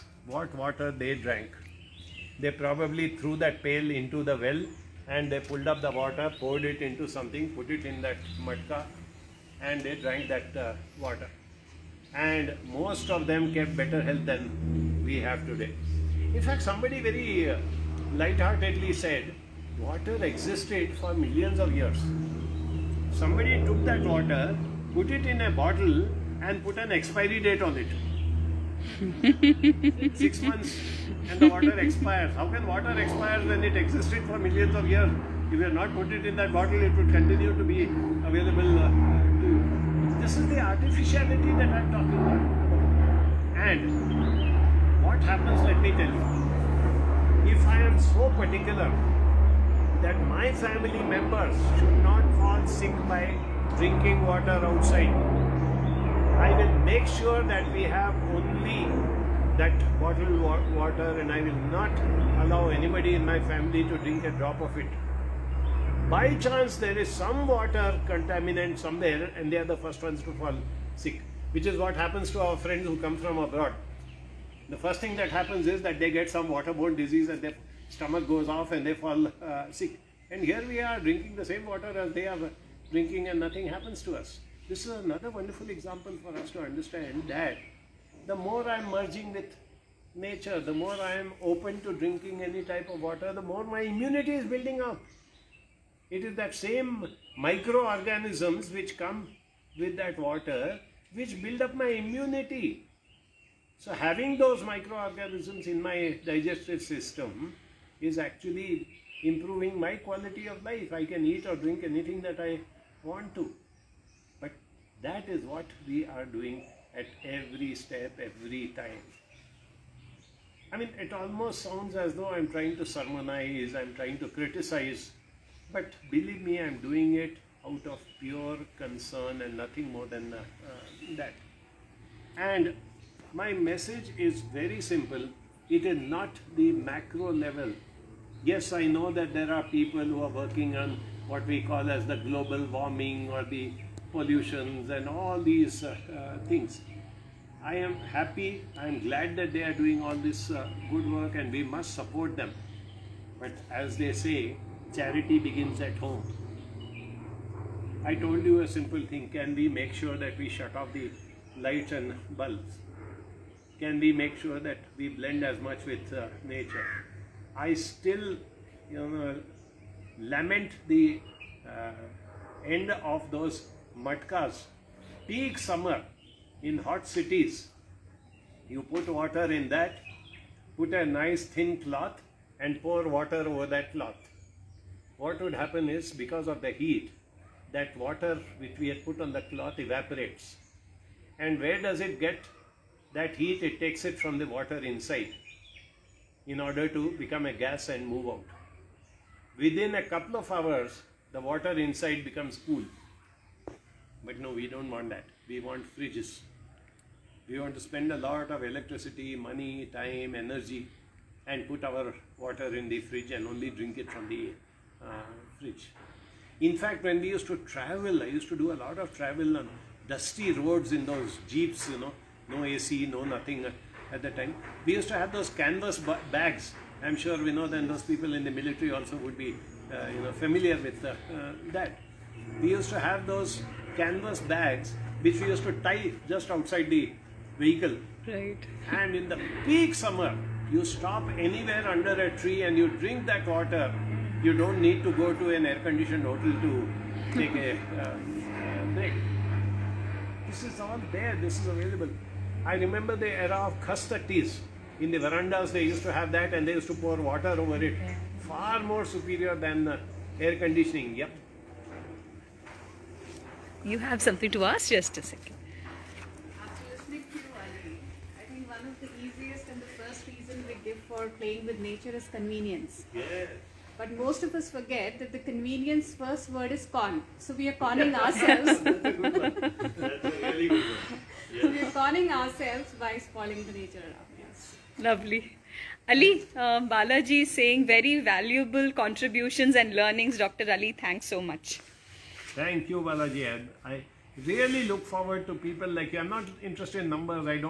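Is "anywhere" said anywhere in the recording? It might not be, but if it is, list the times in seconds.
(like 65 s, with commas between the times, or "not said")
241 s.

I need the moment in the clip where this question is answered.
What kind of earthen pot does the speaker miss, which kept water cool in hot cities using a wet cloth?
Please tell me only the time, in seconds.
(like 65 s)
174 s.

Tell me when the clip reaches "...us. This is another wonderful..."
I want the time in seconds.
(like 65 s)
84 s.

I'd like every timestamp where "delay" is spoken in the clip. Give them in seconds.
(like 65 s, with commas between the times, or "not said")
not said.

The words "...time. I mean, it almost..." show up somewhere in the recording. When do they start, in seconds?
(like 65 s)
118 s.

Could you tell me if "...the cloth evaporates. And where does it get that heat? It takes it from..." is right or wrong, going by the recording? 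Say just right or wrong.
right.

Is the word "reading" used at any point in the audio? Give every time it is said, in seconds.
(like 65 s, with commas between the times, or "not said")
not said.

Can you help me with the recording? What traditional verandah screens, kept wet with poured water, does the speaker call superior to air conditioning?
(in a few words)
khus tatties.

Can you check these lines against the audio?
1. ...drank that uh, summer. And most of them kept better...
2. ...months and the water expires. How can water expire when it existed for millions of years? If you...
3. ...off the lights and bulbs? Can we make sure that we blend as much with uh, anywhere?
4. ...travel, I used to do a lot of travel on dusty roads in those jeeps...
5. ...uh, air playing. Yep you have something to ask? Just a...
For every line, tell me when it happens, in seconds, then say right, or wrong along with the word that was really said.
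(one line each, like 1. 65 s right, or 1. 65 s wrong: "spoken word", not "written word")
1. 9 s wrong: "water", not "summer"
2. 30 s right
3. 160 s wrong: "nature", not "anywhere"
4. 217 s right
5. 259 s wrong: "conditioning", not "playing".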